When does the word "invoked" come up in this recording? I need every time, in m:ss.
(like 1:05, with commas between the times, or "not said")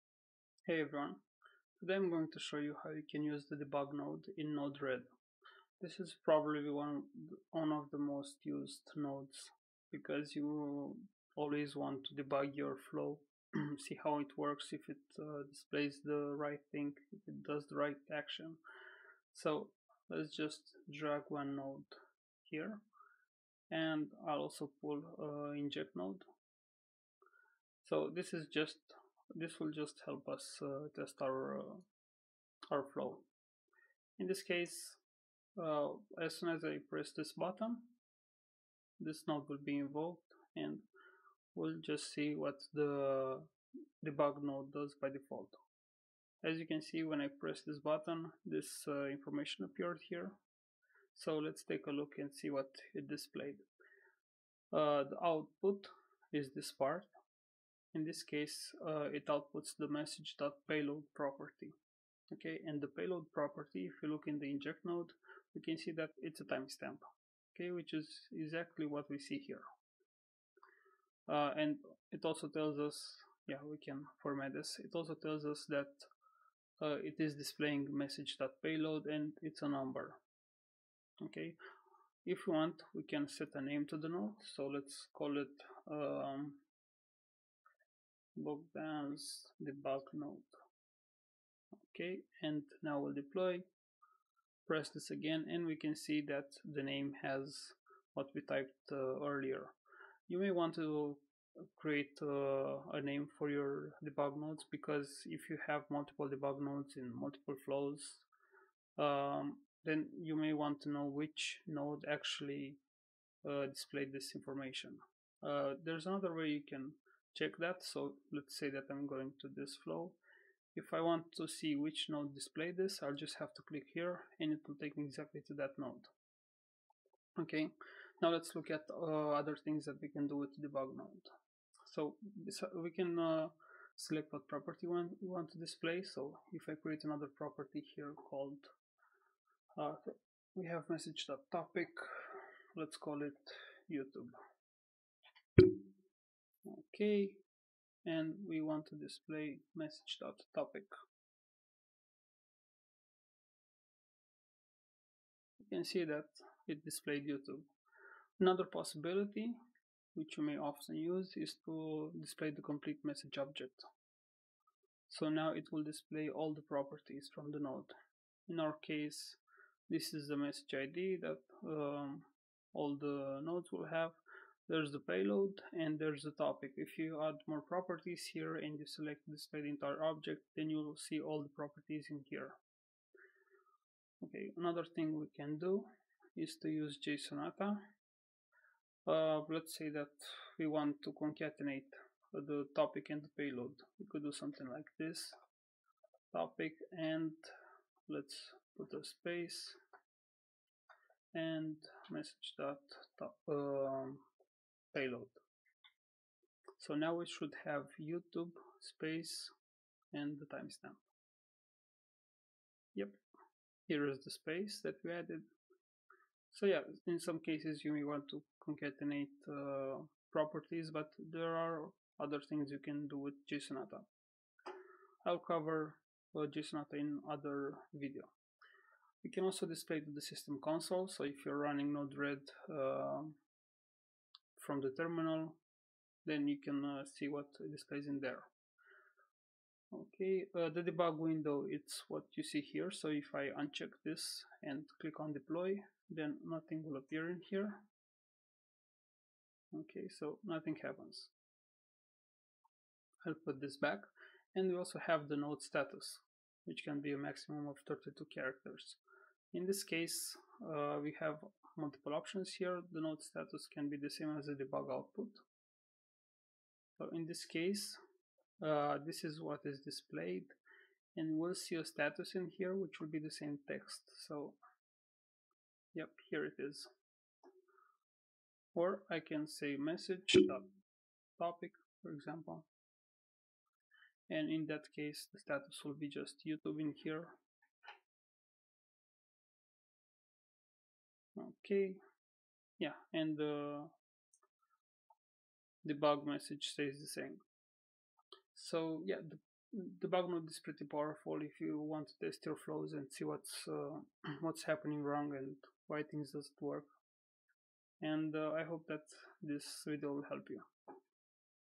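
0:39.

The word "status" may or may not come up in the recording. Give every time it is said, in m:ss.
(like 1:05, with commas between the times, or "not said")
4:15, 4:23, 4:31, 4:45.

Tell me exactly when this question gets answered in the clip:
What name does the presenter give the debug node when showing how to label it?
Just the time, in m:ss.
1:28.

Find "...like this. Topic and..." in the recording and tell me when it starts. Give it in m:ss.
3:14.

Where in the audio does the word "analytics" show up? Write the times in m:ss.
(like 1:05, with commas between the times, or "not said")
not said.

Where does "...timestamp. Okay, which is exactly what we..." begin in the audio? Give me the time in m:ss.
1:06.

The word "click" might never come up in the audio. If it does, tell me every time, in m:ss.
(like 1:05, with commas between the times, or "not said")
2:03, 4:05.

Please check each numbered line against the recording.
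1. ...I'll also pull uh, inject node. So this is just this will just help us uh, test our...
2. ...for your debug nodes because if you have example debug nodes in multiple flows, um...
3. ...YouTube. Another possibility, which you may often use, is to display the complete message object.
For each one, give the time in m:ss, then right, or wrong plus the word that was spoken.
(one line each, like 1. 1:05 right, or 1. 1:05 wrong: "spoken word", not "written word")
1. 0:24 right
2. 1:43 wrong: "multiple", not "example"
3. 2:37 right.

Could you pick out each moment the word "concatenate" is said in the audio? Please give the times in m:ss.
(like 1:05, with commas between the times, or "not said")
3:11, 3:38.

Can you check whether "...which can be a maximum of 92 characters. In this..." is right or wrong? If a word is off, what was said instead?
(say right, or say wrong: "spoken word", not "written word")
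wrong: "32", not "92".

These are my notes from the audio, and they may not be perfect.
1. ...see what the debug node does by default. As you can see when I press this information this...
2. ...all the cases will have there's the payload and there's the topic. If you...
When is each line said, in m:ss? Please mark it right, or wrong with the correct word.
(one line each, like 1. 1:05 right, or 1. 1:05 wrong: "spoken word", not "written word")
1. 0:42 wrong: "button", not "information"
2. 2:52 wrong: "nodes", not "cases".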